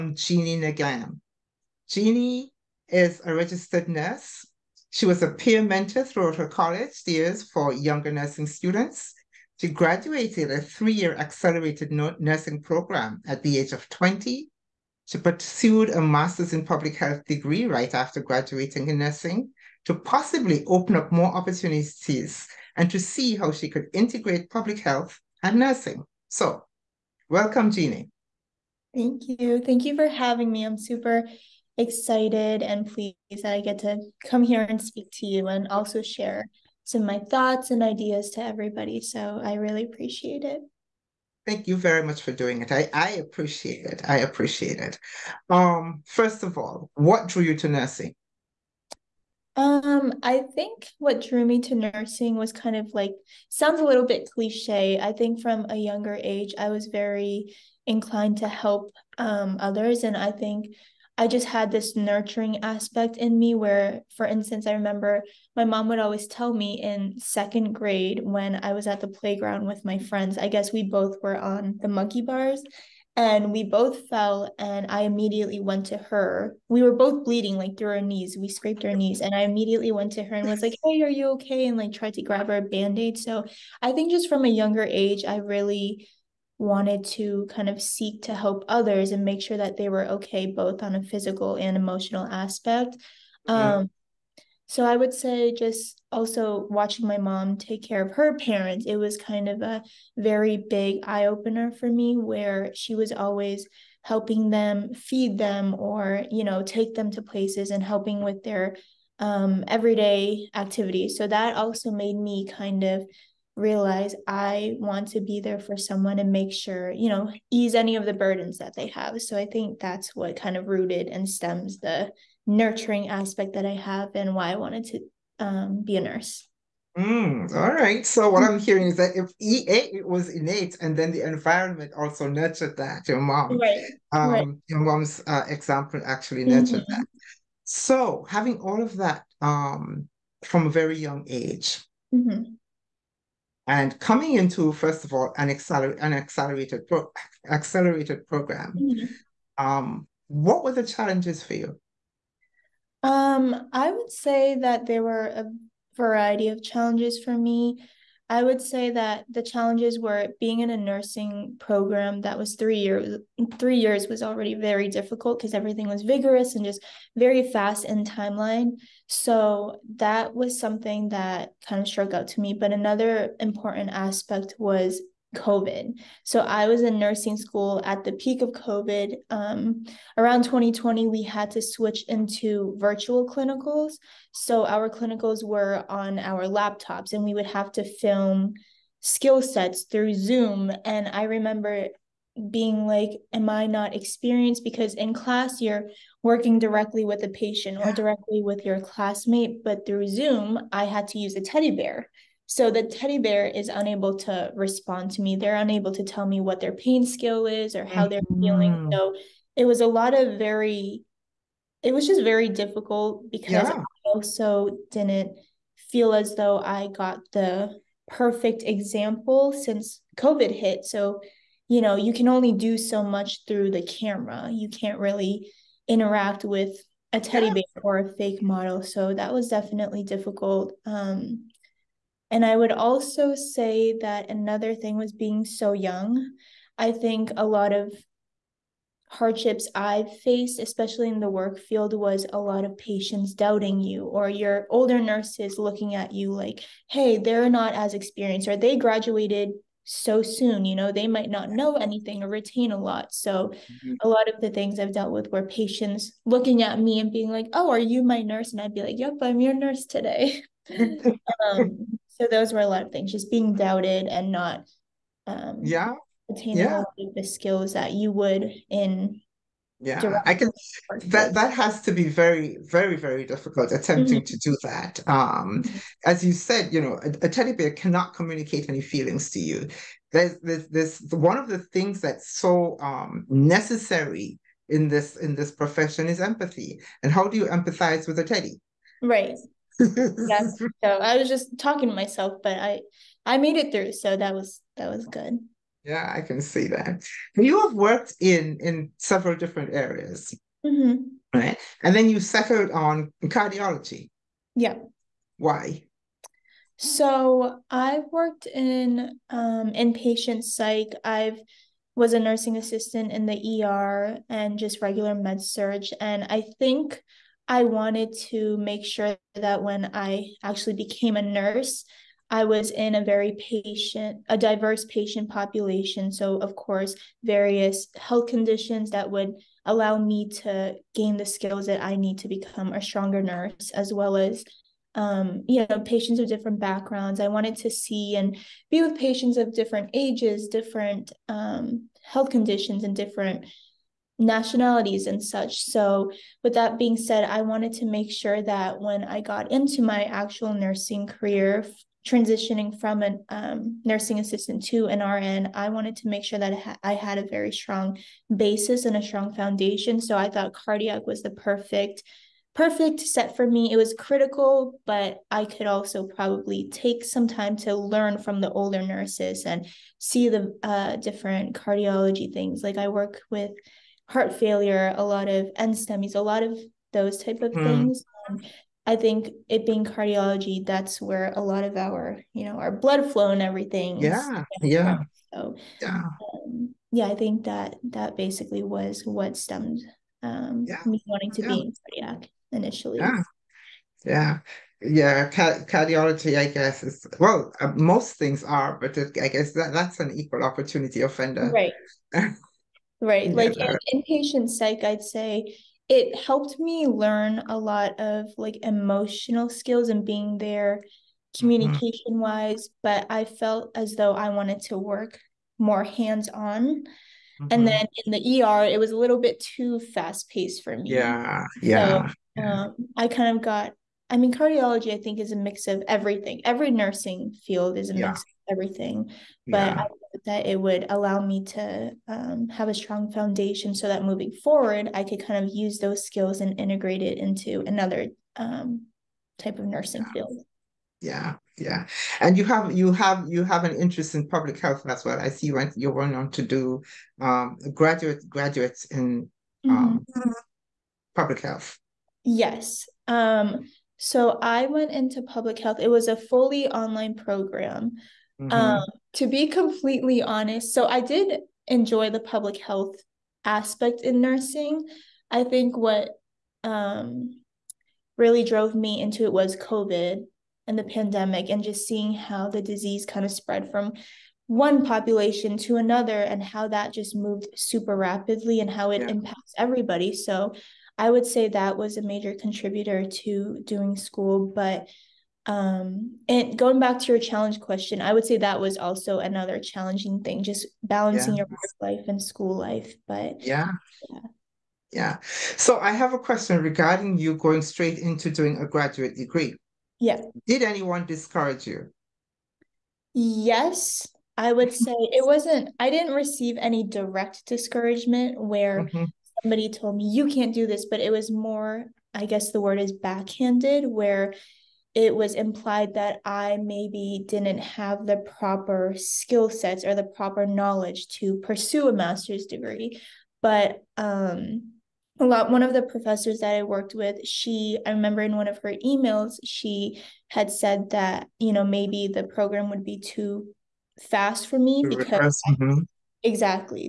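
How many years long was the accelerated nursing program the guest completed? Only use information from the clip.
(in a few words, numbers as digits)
3.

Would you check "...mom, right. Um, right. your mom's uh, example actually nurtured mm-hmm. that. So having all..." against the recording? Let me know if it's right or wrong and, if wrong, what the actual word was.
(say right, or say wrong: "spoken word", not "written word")
right.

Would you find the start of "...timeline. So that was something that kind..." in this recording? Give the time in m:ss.
2:48.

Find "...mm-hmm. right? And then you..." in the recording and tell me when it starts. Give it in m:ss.
5:00.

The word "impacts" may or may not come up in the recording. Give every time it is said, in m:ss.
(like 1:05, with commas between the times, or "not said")
7:59.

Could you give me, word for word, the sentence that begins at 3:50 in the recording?
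Um, and I would also say that another thing was being so young.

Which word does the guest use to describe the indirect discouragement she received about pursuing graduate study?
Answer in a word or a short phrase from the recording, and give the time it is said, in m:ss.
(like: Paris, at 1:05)
Backhanded, at 8:32.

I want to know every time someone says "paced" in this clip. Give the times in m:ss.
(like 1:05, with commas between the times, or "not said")
7:00.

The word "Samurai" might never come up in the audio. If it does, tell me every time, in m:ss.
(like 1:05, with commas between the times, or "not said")
not said.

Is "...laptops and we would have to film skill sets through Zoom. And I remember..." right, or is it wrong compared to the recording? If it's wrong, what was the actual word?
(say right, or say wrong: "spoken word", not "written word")
right.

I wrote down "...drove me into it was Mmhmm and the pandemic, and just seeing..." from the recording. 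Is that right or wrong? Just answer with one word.
wrong.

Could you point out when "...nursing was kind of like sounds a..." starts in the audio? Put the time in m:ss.
0:51.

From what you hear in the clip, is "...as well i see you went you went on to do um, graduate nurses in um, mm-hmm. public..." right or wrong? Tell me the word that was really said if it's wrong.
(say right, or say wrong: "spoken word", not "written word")
wrong: "graduates", not "nurses".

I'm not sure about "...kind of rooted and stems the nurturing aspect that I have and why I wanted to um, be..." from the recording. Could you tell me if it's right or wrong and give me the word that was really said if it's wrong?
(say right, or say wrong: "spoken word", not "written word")
right.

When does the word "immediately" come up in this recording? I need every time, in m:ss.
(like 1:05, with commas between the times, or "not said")
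1:15, 1:19.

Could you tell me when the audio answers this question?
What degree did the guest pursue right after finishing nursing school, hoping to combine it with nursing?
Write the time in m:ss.
0:16.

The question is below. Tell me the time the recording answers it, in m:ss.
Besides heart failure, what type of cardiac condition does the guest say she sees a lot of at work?
6:15.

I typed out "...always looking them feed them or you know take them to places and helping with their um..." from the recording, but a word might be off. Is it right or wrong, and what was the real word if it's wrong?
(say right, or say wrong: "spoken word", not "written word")
wrong: "helping", not "looking".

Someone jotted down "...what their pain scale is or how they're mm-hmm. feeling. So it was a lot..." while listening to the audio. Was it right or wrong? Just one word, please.
right.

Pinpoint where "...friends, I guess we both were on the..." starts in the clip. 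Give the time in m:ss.
1:09.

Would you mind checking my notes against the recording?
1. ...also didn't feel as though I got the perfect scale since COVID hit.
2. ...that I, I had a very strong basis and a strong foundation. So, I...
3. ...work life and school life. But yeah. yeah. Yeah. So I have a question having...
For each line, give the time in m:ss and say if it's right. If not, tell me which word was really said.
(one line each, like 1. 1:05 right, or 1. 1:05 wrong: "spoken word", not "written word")
1. 3:34 wrong: "example", not "scale"
2. 5:56 right
3. 8:11 wrong: "regarding", not "having".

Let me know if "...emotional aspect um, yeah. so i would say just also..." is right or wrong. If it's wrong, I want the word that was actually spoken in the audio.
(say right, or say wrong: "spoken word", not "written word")
right.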